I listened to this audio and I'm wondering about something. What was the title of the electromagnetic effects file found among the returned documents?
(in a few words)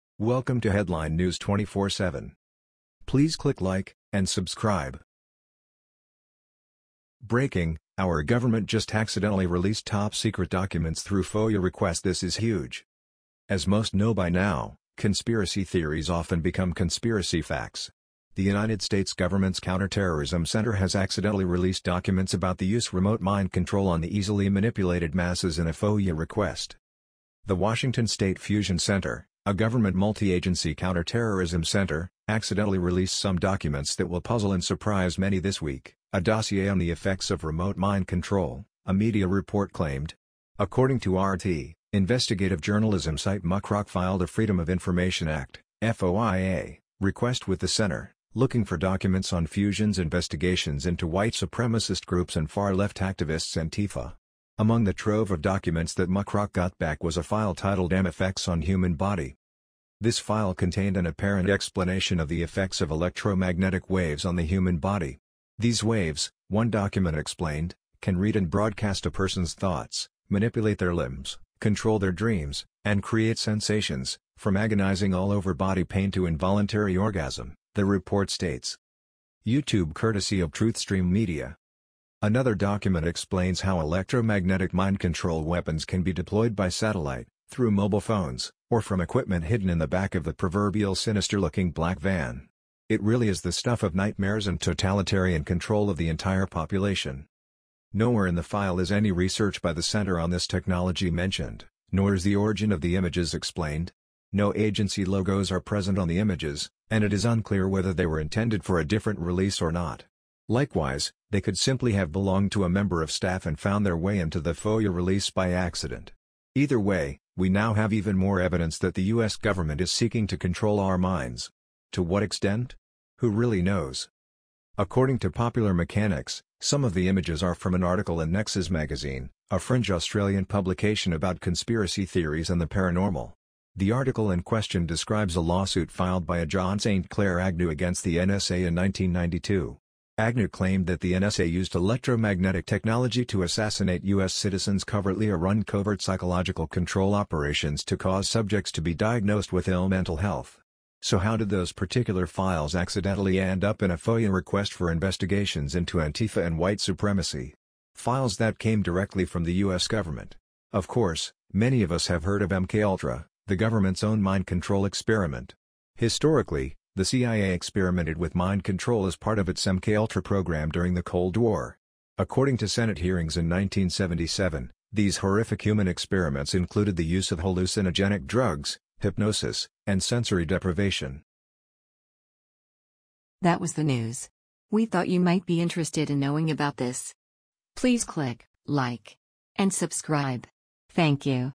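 MFX on Human Body.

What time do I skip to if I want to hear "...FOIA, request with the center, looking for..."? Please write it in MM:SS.
00:45.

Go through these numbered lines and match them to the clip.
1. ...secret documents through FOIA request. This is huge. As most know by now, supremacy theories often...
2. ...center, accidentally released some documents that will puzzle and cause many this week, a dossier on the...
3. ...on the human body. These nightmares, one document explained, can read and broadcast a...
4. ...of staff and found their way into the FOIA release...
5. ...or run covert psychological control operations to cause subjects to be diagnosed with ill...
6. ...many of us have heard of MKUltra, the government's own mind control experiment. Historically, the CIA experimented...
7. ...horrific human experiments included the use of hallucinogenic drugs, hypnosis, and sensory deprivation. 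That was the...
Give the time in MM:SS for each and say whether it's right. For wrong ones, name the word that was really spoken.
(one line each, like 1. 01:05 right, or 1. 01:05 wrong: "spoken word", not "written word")
1. 00:10 wrong: "conspiracy", not "supremacy"
2. 00:31 wrong: "surprise", not "cause"
3. 01:04 wrong: "waves", not "nightmares"
4. 01:53 right
5. 02:25 right
6. 02:41 right
7. 02:55 right.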